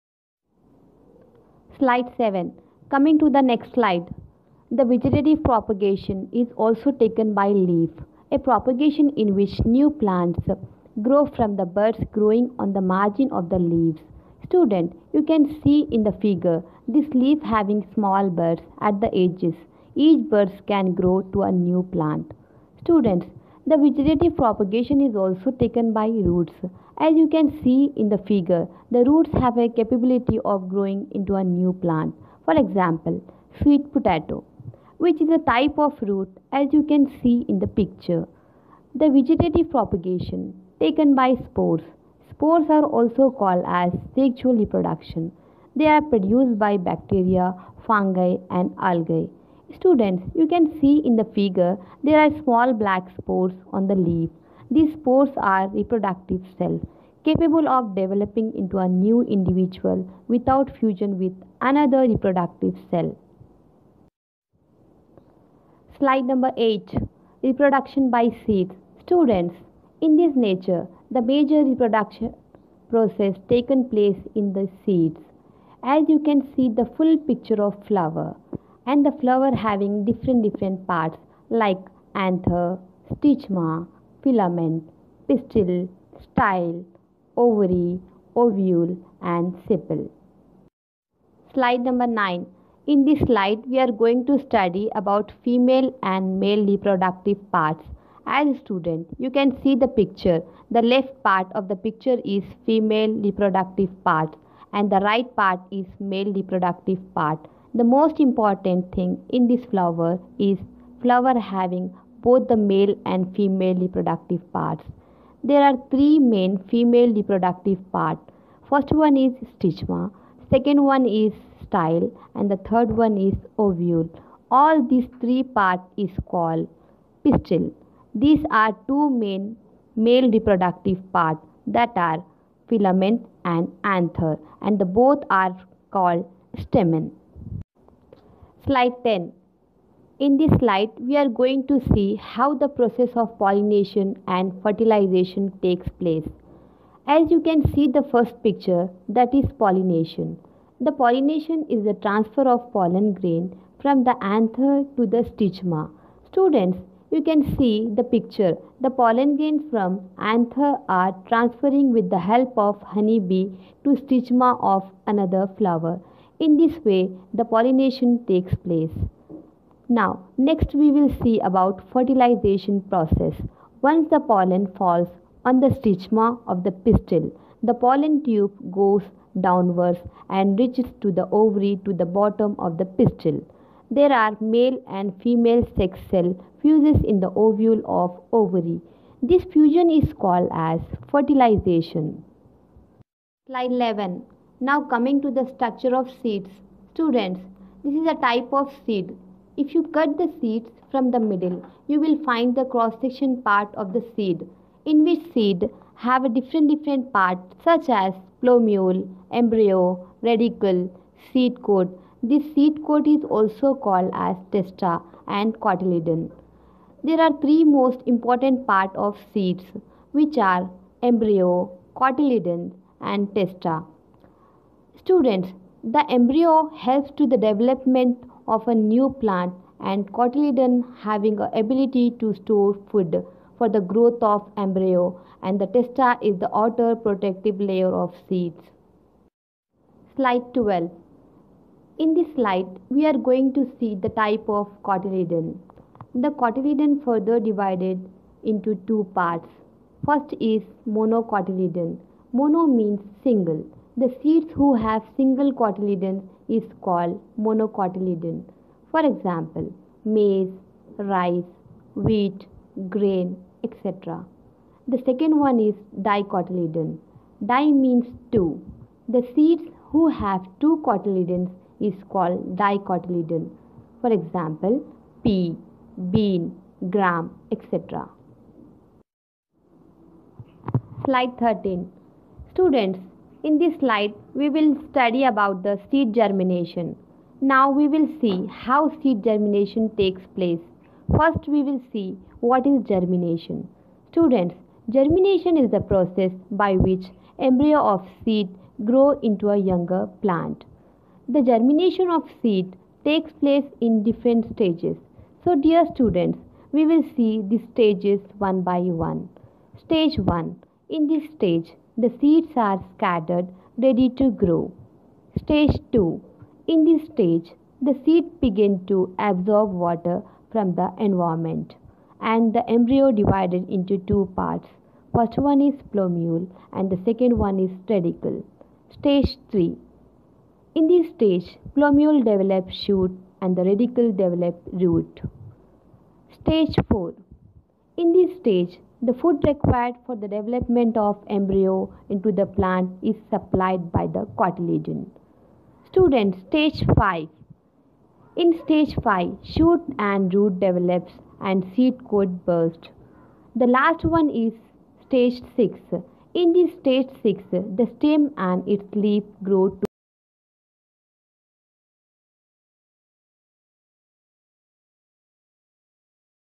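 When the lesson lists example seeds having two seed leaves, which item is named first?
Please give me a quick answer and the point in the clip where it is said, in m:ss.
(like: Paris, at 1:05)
Pea, at 4:35.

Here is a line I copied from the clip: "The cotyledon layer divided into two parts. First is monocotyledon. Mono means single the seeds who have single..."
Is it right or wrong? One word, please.
wrong.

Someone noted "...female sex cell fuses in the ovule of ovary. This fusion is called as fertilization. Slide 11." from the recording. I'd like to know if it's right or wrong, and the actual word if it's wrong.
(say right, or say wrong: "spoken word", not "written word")
right.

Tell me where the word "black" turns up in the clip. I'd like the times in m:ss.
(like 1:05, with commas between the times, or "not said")
0:52.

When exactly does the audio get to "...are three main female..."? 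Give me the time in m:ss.
1:55.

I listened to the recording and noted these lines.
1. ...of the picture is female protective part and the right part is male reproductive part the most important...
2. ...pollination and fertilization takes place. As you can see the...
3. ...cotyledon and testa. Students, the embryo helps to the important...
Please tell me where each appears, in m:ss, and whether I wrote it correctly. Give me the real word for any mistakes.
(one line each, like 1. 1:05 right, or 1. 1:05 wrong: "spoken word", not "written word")
1. 1:41 wrong: "reproductive", not "protective"
2. 2:23 right
3. 3:41 wrong: "development", not "important".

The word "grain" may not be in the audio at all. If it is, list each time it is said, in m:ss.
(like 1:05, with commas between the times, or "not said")
2:33, 2:39, 4:22.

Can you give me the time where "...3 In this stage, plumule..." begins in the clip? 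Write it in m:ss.
5:29.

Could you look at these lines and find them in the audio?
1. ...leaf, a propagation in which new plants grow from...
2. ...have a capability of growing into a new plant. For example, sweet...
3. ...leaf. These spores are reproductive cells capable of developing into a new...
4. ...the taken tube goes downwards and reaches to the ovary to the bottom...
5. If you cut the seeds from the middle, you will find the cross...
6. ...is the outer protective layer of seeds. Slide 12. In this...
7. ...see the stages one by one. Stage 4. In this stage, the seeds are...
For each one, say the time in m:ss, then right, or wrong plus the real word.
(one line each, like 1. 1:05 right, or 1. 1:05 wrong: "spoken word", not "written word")
1. 0:07 right
2. 0:29 right
3. 0:53 right
4. 2:57 wrong: "pollen", not "taken"
5. 3:19 right
6. 3:56 right
7. 5:07 wrong: "1", not "4".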